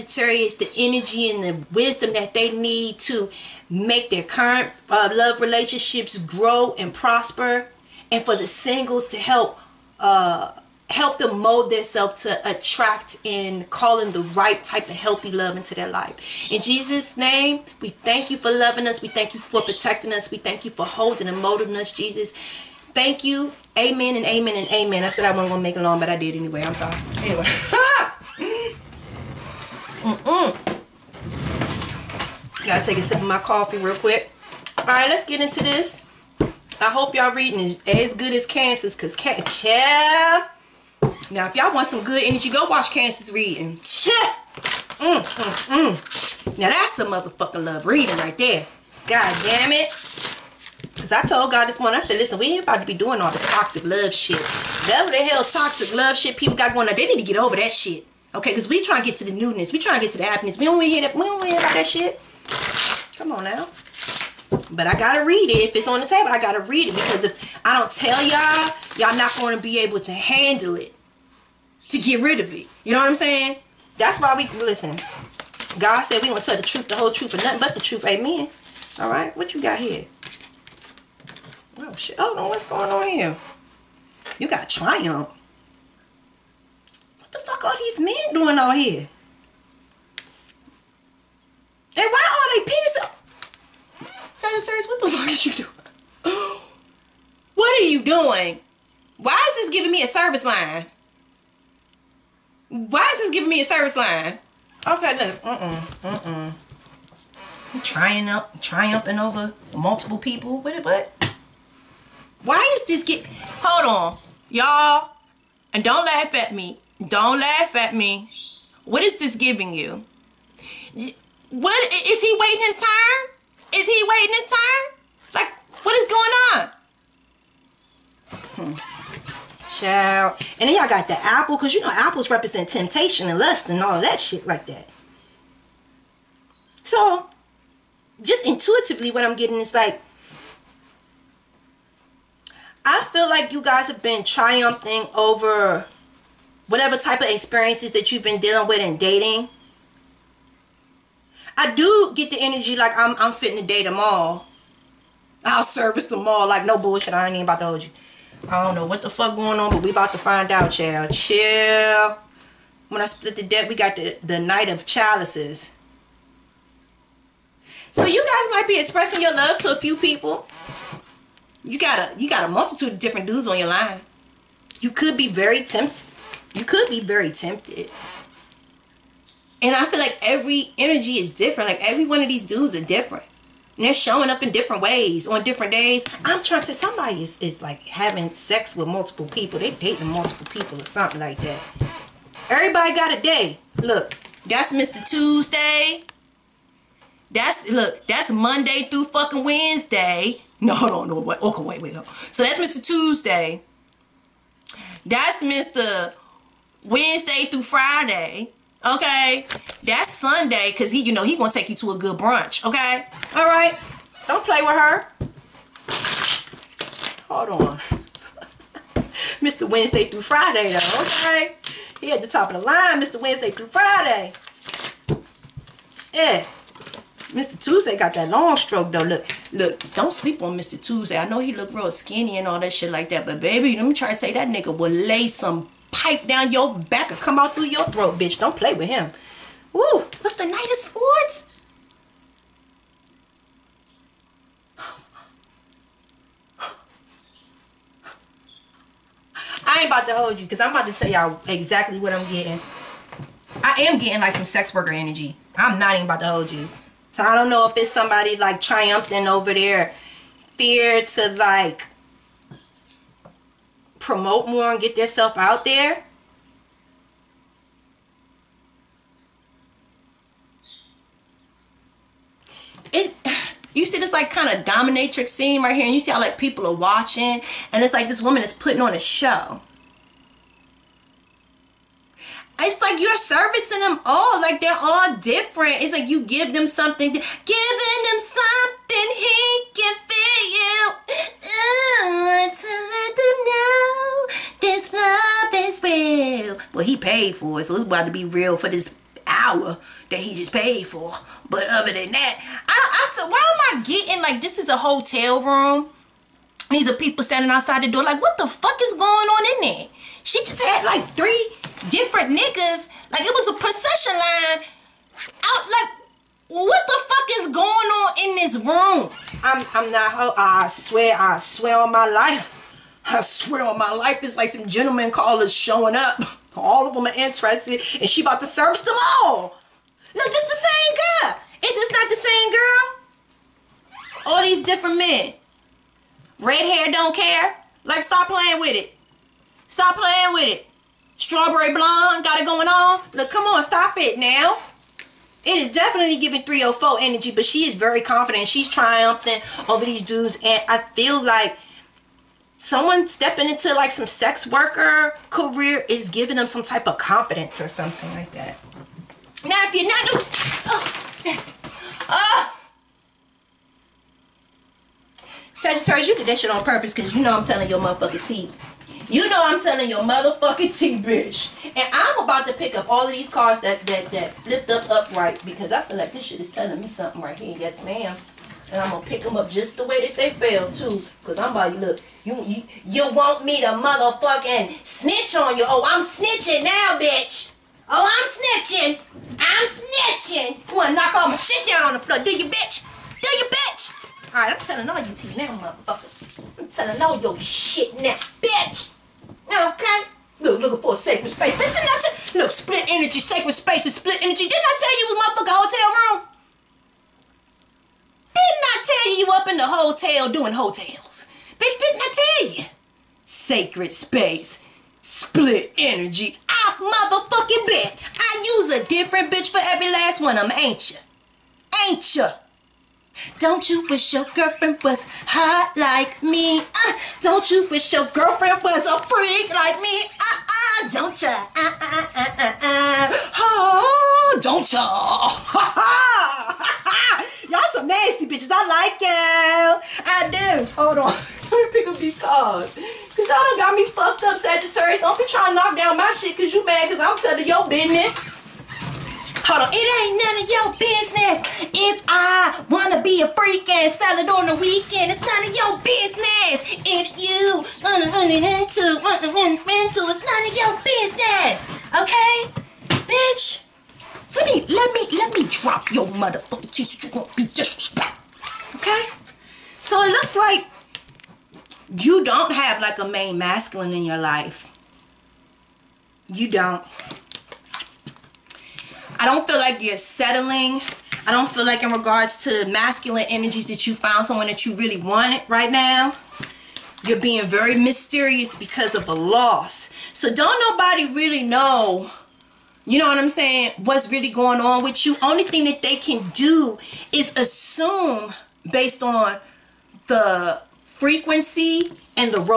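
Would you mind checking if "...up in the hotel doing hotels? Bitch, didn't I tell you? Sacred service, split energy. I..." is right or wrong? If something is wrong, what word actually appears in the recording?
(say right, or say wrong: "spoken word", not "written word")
wrong: "space", not "service".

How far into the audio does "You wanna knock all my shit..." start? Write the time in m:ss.
6:30.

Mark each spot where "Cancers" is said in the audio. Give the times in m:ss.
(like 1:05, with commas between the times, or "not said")
0:38, 0:42.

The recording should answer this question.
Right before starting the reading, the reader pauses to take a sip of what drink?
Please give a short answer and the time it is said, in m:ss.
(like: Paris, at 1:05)
coffee, at 0:33.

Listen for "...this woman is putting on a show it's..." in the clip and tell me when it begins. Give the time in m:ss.
4:38.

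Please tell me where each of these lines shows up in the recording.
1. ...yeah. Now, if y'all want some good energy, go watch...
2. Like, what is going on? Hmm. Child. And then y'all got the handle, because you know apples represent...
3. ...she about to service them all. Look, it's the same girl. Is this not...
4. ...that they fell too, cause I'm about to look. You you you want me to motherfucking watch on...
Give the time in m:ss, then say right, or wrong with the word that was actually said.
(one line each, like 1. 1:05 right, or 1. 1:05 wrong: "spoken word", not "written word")
1. 0:39 right
2. 2:05 wrong: "apple", not "handle"
3. 5:28 right
4. 6:19 wrong: "snitch", not "watch".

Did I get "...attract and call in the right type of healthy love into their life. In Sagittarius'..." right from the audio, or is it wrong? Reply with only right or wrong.
wrong.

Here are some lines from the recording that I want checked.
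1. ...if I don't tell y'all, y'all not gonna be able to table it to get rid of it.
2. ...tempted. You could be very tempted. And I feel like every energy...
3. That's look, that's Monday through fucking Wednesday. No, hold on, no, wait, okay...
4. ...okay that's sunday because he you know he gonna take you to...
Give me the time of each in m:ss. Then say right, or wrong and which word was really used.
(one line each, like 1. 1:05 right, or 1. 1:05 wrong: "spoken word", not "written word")
1. 1:07 wrong: "handle", not "table"
2. 2:55 right
3. 3:17 right
4. 3:28 right.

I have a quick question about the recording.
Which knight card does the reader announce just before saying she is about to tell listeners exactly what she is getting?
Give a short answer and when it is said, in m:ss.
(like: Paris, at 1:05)
Knight of Swords, at 4:00.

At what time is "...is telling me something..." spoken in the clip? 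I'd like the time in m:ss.
6:16.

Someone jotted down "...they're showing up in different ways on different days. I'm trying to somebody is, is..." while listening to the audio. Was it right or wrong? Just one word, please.
right.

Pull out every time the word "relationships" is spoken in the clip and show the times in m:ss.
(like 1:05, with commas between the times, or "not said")
0:05.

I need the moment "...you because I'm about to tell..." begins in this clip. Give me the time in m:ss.
4:10.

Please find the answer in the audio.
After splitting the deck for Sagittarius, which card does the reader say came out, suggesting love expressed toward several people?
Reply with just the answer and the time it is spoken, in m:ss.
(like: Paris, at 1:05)
Knight of Chalices, at 2:44.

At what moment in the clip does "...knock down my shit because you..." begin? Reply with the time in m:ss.
7:25.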